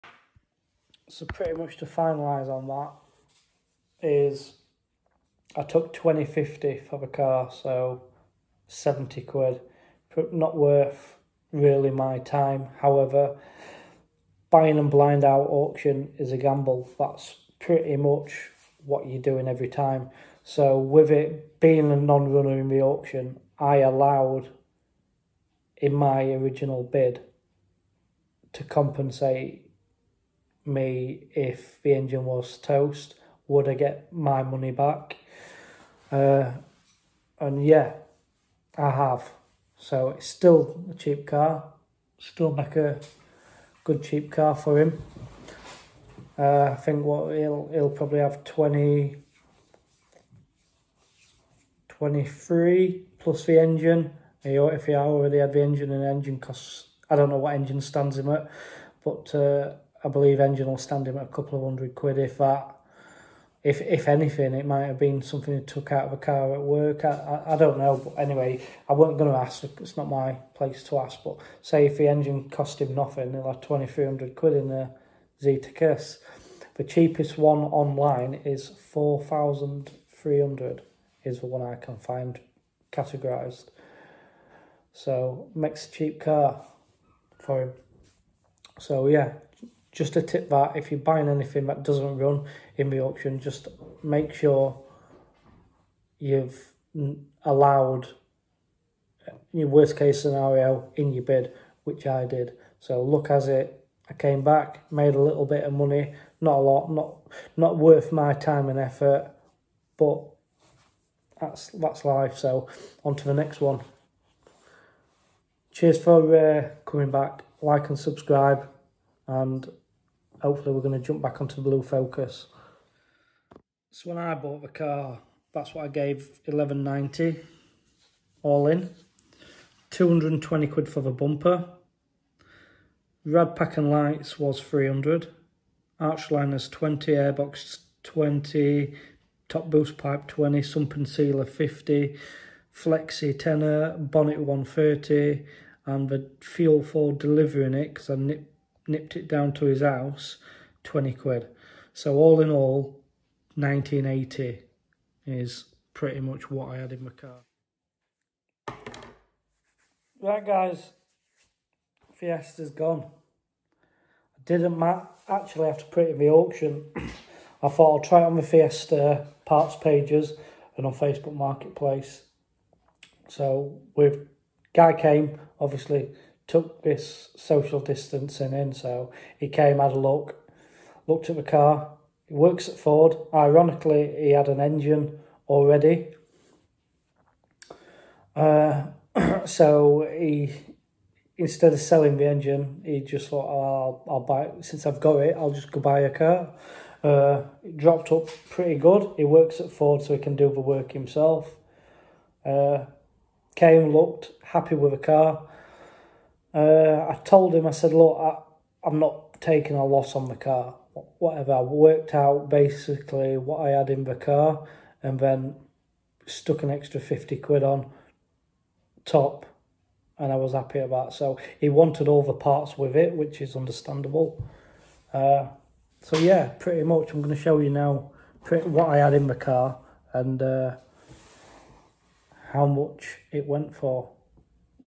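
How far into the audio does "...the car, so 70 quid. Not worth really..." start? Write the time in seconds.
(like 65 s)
6 s.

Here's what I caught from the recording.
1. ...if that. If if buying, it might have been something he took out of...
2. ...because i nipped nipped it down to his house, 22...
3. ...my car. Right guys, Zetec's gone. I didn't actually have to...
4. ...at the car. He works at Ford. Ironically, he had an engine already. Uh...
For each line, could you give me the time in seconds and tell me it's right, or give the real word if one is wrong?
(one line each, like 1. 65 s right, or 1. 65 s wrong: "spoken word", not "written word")
1. 62 s wrong: "anything", not "buying"
2. 147 s wrong: "20", not "22"
3. 157 s wrong: "Fiesta", not "Zetec"
4. 181 s right.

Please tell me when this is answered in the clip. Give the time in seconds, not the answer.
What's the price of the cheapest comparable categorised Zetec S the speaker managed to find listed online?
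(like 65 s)
78 s.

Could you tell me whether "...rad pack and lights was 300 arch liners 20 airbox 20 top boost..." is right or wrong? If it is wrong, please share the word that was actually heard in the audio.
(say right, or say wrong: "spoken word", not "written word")
right.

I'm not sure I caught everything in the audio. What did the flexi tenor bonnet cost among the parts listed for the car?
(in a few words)
130.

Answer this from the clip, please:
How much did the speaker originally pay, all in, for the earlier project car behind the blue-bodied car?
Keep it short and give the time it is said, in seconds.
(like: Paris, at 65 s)
1190, at 126 s.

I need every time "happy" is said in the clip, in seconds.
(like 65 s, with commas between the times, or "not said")
204 s, 220 s.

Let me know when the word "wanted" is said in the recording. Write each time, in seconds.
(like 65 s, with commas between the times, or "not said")
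221 s.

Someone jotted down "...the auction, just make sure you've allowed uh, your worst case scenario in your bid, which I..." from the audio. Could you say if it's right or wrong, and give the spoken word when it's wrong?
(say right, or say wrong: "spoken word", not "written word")
right.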